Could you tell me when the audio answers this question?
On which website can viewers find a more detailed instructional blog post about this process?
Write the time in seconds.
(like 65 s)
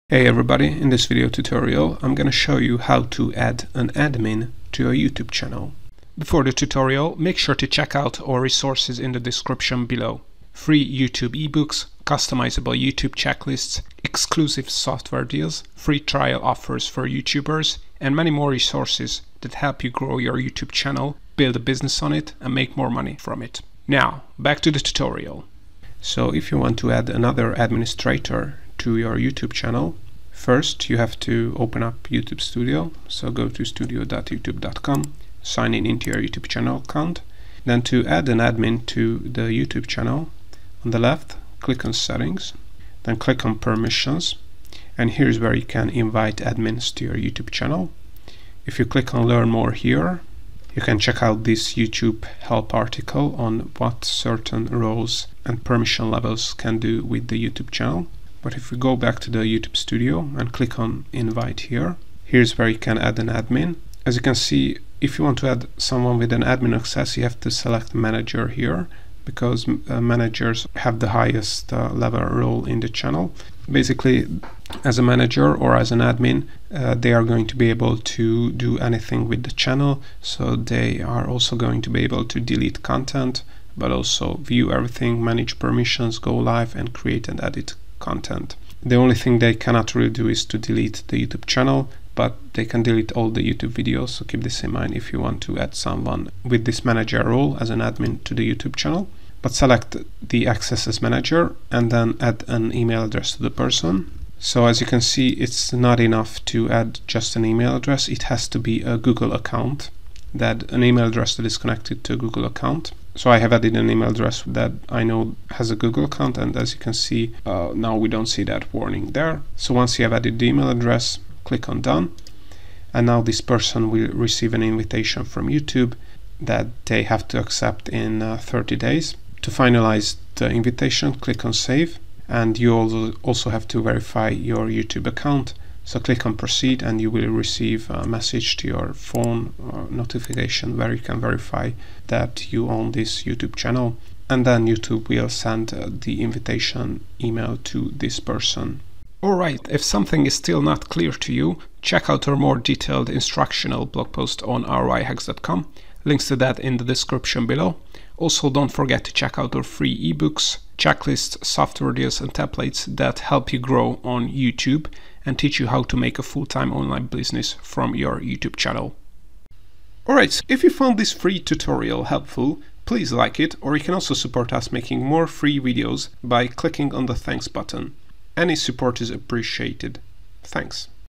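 154 s.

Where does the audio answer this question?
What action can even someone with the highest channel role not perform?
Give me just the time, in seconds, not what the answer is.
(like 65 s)
90 s.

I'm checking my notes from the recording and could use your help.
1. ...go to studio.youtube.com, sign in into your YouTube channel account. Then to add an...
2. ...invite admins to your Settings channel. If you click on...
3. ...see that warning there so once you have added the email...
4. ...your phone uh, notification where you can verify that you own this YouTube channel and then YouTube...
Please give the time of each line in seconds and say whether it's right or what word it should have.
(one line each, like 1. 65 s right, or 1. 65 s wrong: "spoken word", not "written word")
1. 33 s right
2. 45 s wrong: "YouTube", not "Settings"
3. 118 s right
4. 138 s right.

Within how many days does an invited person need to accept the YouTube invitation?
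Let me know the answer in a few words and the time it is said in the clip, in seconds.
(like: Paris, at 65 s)
30, at 128 s.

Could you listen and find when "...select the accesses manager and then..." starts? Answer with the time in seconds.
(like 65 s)
99 s.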